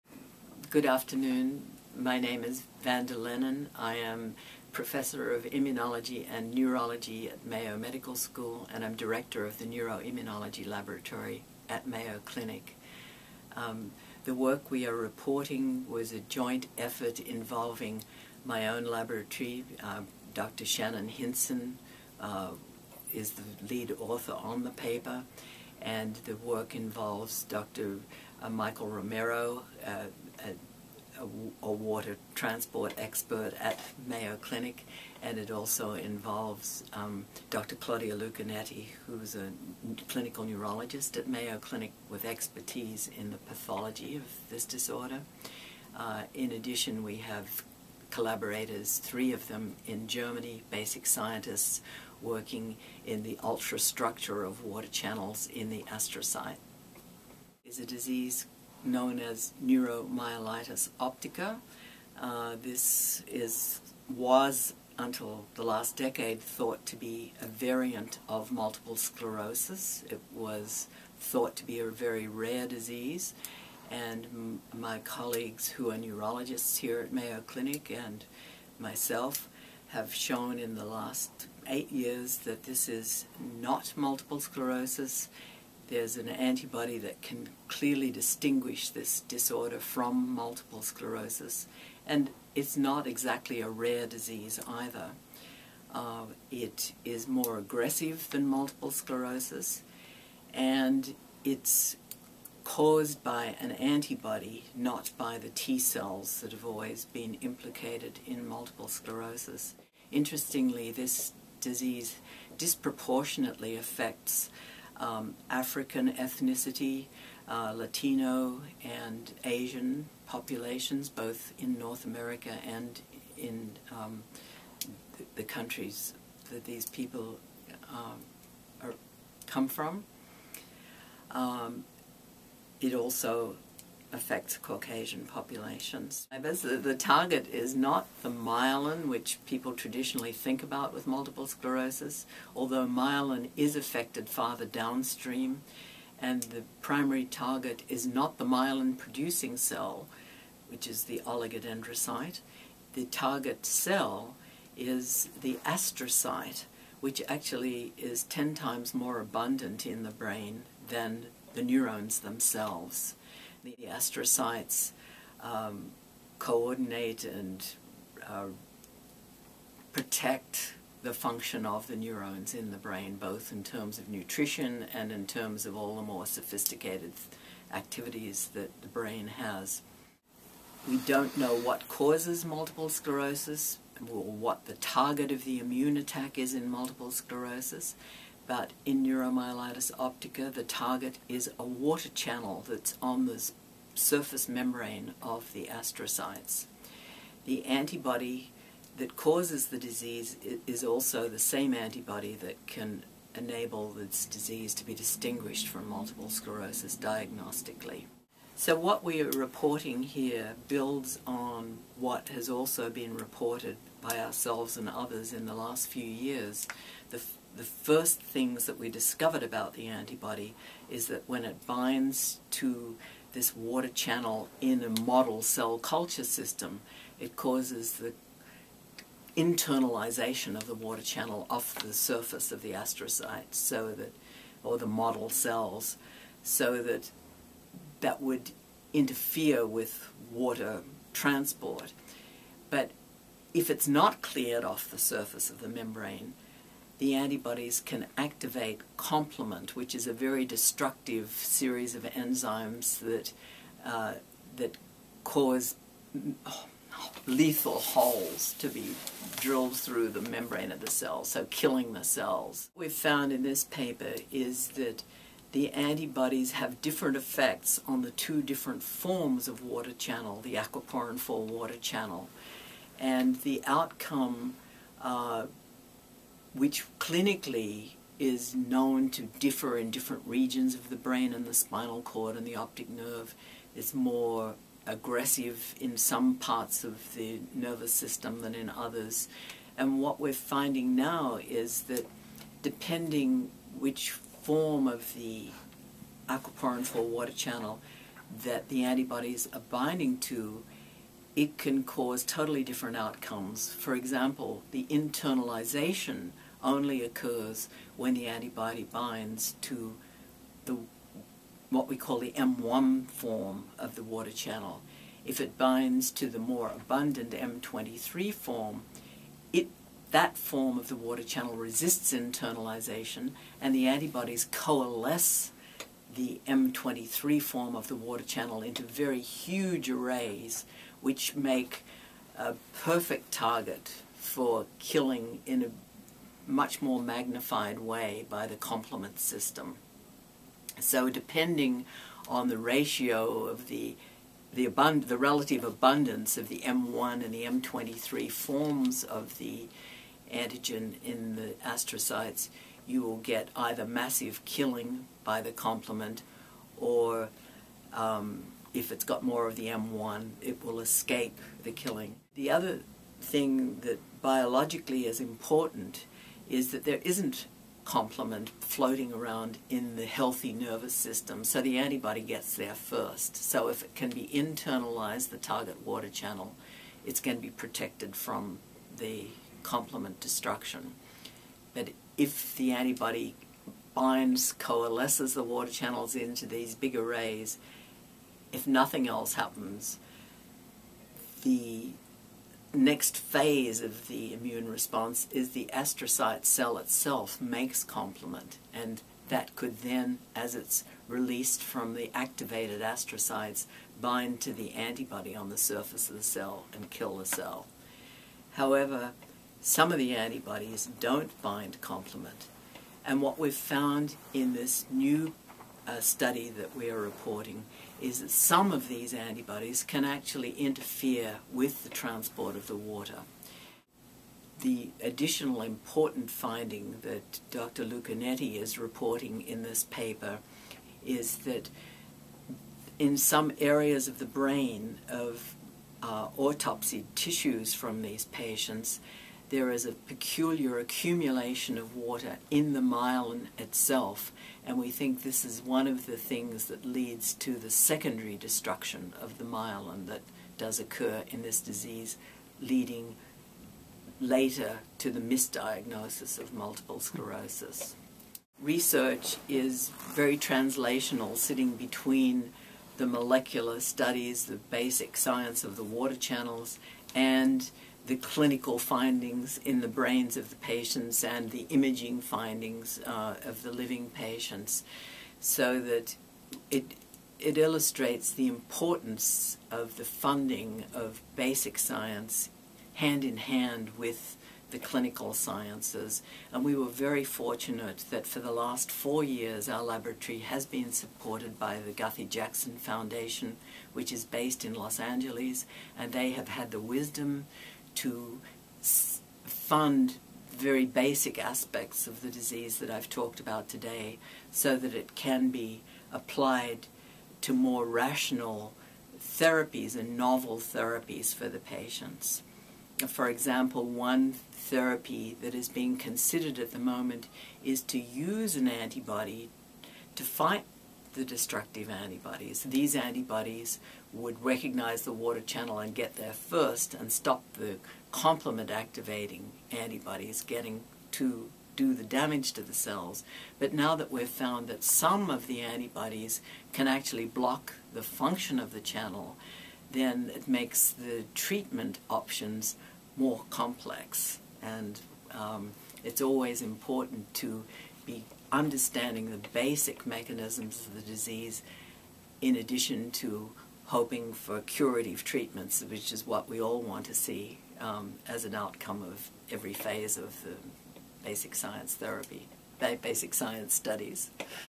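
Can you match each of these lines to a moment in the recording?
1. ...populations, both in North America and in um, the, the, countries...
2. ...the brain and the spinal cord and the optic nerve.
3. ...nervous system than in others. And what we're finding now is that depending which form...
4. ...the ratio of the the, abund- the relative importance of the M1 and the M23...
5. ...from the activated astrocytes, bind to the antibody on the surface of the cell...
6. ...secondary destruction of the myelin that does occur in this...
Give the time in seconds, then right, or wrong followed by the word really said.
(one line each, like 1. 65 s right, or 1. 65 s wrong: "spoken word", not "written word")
1. 120 s right
2. 280 s right
3. 287 s right
4. 342 s wrong: "abundance", not "importance"
5. 401 s right
6. 447 s right.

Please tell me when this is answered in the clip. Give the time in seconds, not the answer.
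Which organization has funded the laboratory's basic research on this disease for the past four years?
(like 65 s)
491 s.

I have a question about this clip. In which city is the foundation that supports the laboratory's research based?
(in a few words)
Los Angeles.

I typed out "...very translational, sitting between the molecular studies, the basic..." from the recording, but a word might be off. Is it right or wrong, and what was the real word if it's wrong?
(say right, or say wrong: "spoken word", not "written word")
right.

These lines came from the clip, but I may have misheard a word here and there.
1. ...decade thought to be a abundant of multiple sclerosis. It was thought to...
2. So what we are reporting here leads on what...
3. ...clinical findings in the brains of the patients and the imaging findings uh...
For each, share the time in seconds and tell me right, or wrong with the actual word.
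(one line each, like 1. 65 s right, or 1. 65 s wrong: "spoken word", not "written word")
1. 65 s wrong: "variant", not "abundant"
2. 208 s wrong: "builds", not "leads"
3. 468 s right.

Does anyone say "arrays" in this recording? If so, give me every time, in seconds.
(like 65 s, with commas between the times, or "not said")
329 s, 386 s.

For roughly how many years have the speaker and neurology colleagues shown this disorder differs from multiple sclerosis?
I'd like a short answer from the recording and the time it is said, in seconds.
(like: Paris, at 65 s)
8 years, at 81 s.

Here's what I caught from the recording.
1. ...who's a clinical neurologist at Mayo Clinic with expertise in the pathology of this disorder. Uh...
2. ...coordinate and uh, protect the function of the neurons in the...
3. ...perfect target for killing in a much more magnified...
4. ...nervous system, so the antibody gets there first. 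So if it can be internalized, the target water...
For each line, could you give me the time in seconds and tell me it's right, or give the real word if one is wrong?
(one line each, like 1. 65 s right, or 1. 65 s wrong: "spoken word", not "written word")
1. 39 s right
2. 166 s right
3. 332 s right
4. 370 s right.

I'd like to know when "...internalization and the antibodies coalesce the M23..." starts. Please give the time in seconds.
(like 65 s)
322 s.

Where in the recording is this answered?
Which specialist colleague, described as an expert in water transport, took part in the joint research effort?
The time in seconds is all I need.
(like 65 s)
28 s.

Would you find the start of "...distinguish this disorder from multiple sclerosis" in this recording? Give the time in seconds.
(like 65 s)
88 s.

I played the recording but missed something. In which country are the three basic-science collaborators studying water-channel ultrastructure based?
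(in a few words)
Germany.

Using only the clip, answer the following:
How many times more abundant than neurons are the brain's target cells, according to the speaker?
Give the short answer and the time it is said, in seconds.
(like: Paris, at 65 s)
10 times, at 158 s.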